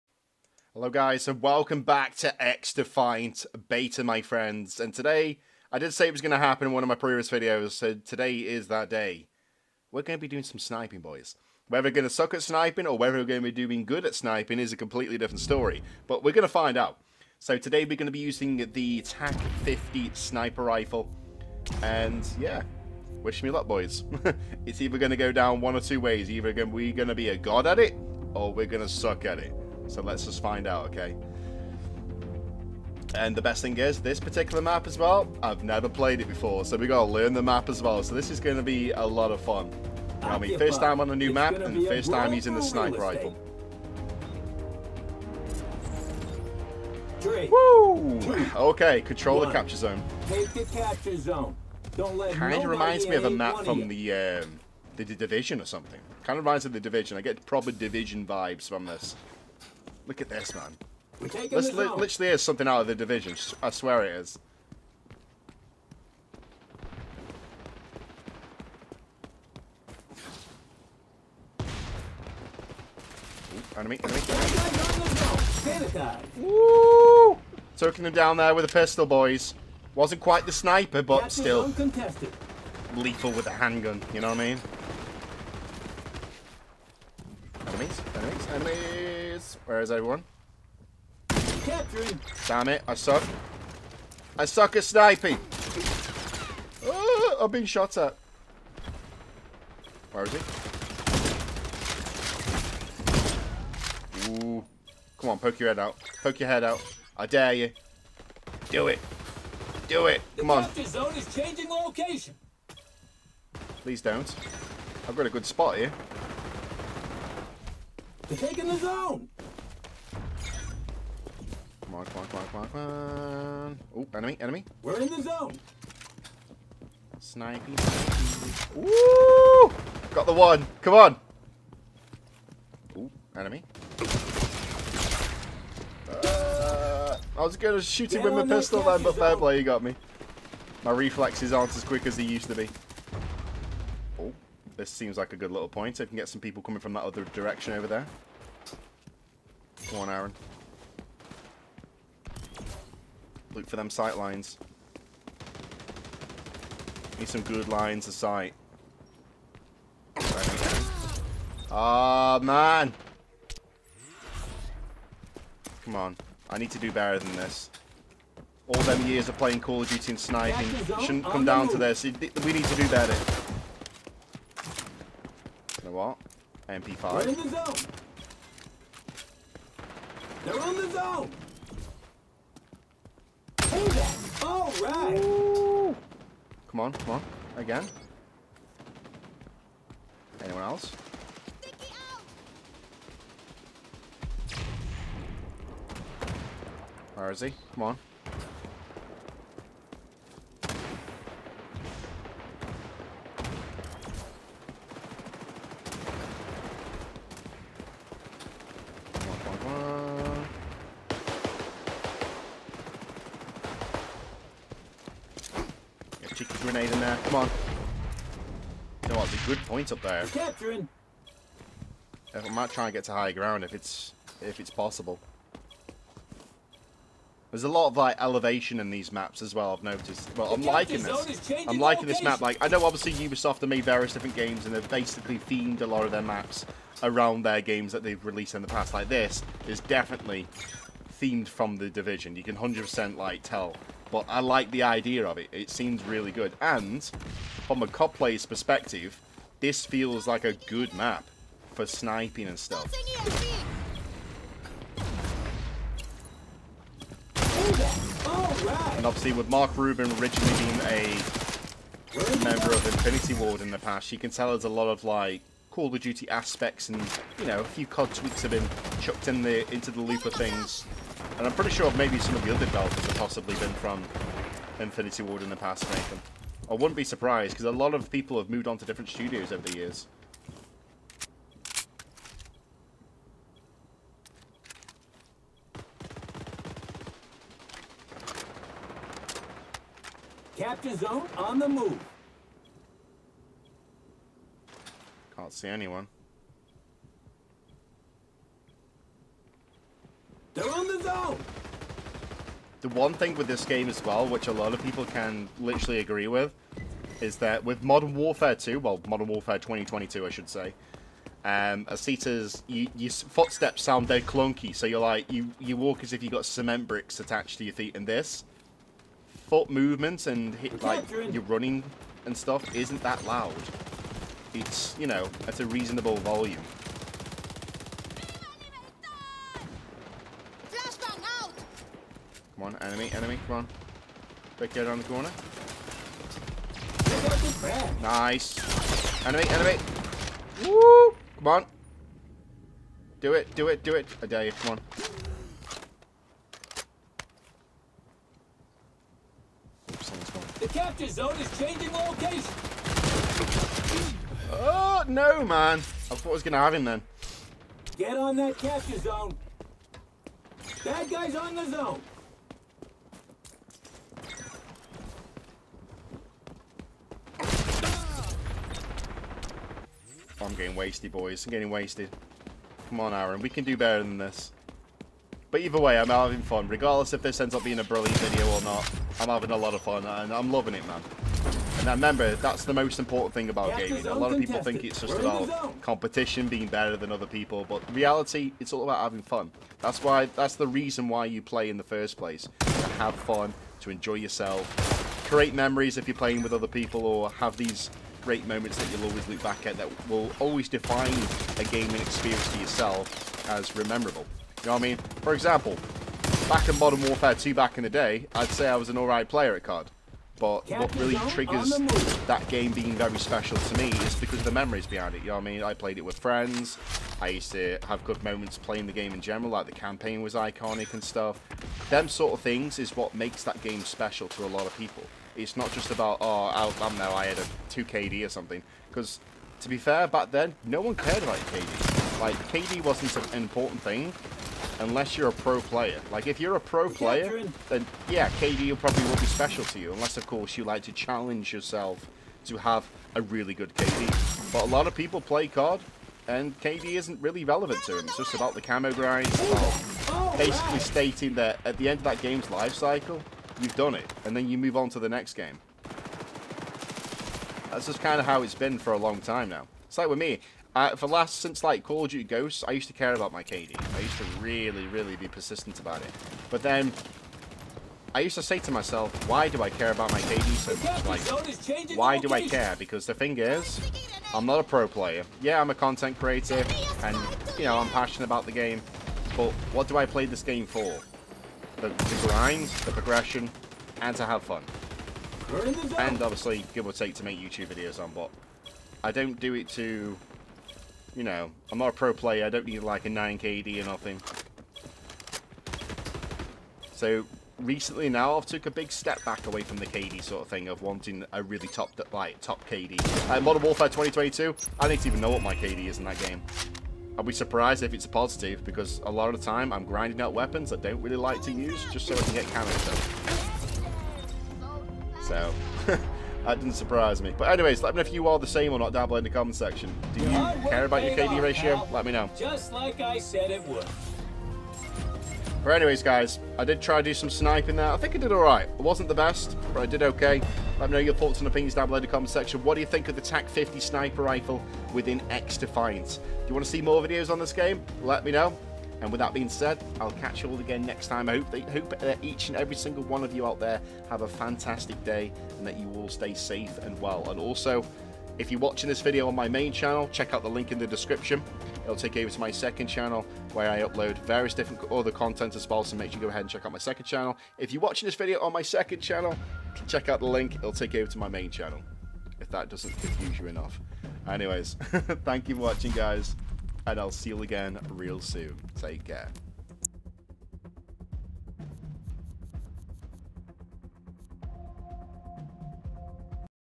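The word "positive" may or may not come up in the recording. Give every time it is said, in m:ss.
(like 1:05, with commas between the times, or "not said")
8:28.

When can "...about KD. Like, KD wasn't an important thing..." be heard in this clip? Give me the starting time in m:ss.
7:11.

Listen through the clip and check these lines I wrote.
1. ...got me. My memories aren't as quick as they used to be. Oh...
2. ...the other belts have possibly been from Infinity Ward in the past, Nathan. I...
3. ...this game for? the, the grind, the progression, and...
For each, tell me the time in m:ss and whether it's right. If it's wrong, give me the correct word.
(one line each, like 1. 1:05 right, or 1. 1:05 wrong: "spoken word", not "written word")
1. 2:19 wrong: "reflexes", not "memories"
2. 4:32 right
3. 8:00 right.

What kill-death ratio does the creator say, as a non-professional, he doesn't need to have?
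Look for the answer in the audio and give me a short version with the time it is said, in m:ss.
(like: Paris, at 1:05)
9 KD, at 8:13.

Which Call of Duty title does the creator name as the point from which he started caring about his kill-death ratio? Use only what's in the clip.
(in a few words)
Call of Duty Ghosts.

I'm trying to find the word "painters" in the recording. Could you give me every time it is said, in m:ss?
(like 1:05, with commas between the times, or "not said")
not said.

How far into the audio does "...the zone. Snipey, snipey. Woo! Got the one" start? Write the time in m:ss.
2:05.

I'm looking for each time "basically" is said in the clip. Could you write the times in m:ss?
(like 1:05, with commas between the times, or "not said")
3:54, 7:30.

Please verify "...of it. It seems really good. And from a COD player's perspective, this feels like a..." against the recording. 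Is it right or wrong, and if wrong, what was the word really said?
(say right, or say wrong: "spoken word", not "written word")
right.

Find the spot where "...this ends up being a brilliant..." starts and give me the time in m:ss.
6:17.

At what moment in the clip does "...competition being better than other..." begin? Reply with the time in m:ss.
6:25.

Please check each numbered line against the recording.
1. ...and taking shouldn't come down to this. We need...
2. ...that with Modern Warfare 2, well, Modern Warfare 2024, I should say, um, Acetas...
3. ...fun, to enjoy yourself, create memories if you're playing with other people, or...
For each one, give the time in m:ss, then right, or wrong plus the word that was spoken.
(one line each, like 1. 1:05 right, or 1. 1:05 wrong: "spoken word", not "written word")
1. 2:50 wrong: "sniping", not "taking"
2. 5:07 wrong: "2022", not "2024"
3. 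6:33 right.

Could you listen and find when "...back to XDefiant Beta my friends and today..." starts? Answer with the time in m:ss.
0:01.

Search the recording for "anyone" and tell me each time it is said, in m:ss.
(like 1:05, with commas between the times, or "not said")
3:10, 4:55.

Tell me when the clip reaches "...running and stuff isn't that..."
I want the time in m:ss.
5:21.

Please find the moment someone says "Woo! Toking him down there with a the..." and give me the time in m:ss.
1:16.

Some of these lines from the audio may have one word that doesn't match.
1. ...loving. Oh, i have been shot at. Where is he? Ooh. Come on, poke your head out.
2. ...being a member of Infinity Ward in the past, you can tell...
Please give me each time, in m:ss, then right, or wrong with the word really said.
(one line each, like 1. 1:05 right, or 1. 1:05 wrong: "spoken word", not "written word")
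1. 1:34 wrong: "sniping", not "loving"
2. 4:20 right.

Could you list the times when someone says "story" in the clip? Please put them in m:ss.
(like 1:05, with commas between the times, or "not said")
0:15.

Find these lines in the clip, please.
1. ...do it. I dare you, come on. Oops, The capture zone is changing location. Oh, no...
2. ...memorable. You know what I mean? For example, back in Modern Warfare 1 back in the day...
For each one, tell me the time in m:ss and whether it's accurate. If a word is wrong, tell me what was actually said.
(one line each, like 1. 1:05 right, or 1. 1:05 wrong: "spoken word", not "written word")
1. 5:43 right
2. 6:43 wrong: "2", not "1".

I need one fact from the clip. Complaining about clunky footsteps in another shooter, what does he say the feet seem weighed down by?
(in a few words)
Cement bricks.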